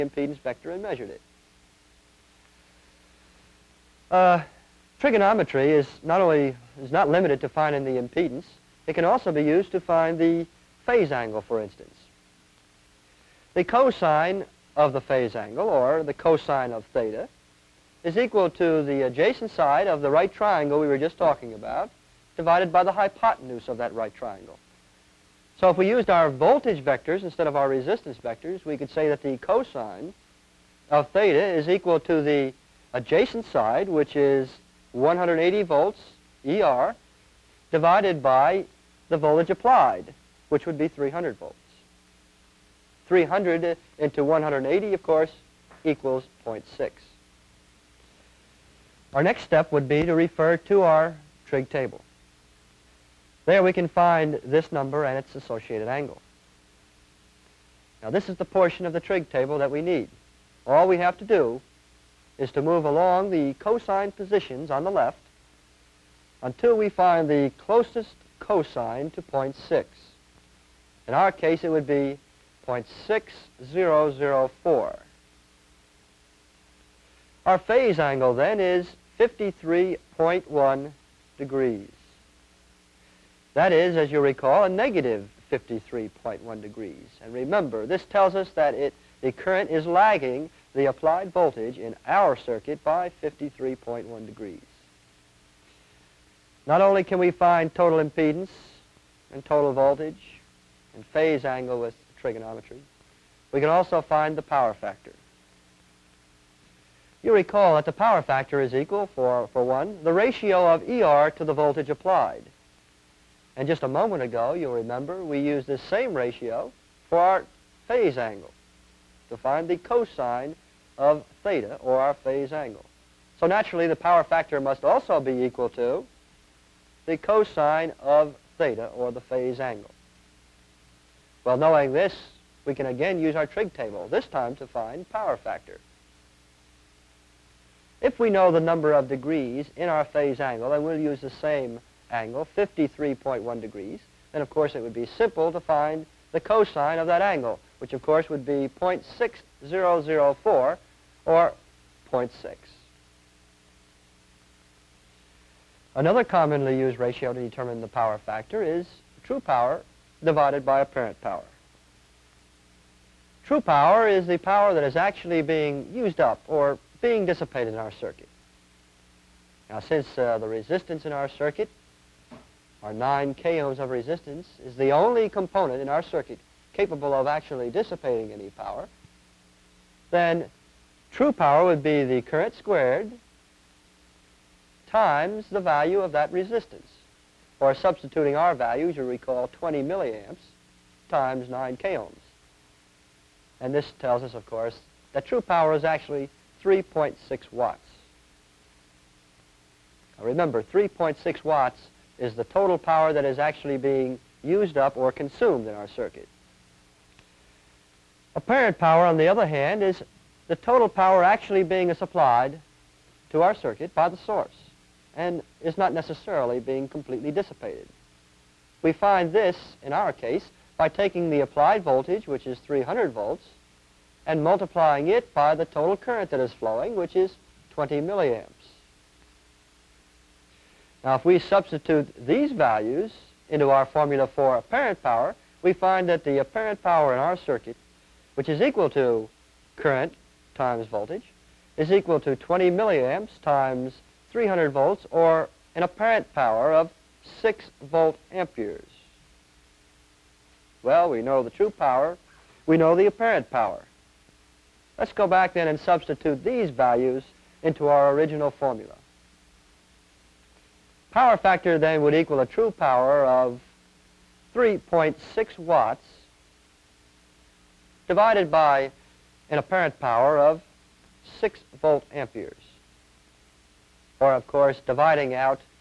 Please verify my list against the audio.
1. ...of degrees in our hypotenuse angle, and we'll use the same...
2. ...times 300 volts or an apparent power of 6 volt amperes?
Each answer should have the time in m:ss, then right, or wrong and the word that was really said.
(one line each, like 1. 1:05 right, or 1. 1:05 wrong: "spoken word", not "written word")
1. 2:18 wrong: "phase", not "hypotenuse"
2. 4:03 right.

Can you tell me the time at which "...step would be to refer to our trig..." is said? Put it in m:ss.
0:49.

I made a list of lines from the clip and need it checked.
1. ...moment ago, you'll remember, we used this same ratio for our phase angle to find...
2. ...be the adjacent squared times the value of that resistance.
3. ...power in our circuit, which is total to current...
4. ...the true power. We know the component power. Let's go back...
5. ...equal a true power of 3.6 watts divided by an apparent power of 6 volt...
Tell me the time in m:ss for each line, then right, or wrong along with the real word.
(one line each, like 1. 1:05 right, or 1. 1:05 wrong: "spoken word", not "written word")
1. 1:53 right
2. 3:01 wrong: "current", not "adjacent"
3. 3:56 wrong: "equal", not "total"
4. 4:11 wrong: "apparent", not "component"
5. 4:22 right.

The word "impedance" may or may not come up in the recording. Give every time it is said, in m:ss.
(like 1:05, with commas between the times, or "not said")
0:08, 1:38.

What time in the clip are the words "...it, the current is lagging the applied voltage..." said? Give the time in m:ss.
1:28.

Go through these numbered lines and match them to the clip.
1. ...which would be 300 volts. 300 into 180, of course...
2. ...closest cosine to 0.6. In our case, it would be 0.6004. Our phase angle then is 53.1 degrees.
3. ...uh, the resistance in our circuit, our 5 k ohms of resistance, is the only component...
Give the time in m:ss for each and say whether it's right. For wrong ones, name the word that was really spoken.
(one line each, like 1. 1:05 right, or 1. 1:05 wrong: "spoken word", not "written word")
1. 0:40 right
2. 1:07 right
3. 2:50 wrong: "9", not "5".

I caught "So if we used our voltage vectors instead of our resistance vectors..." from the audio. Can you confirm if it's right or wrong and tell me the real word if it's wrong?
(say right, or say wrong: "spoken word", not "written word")
right.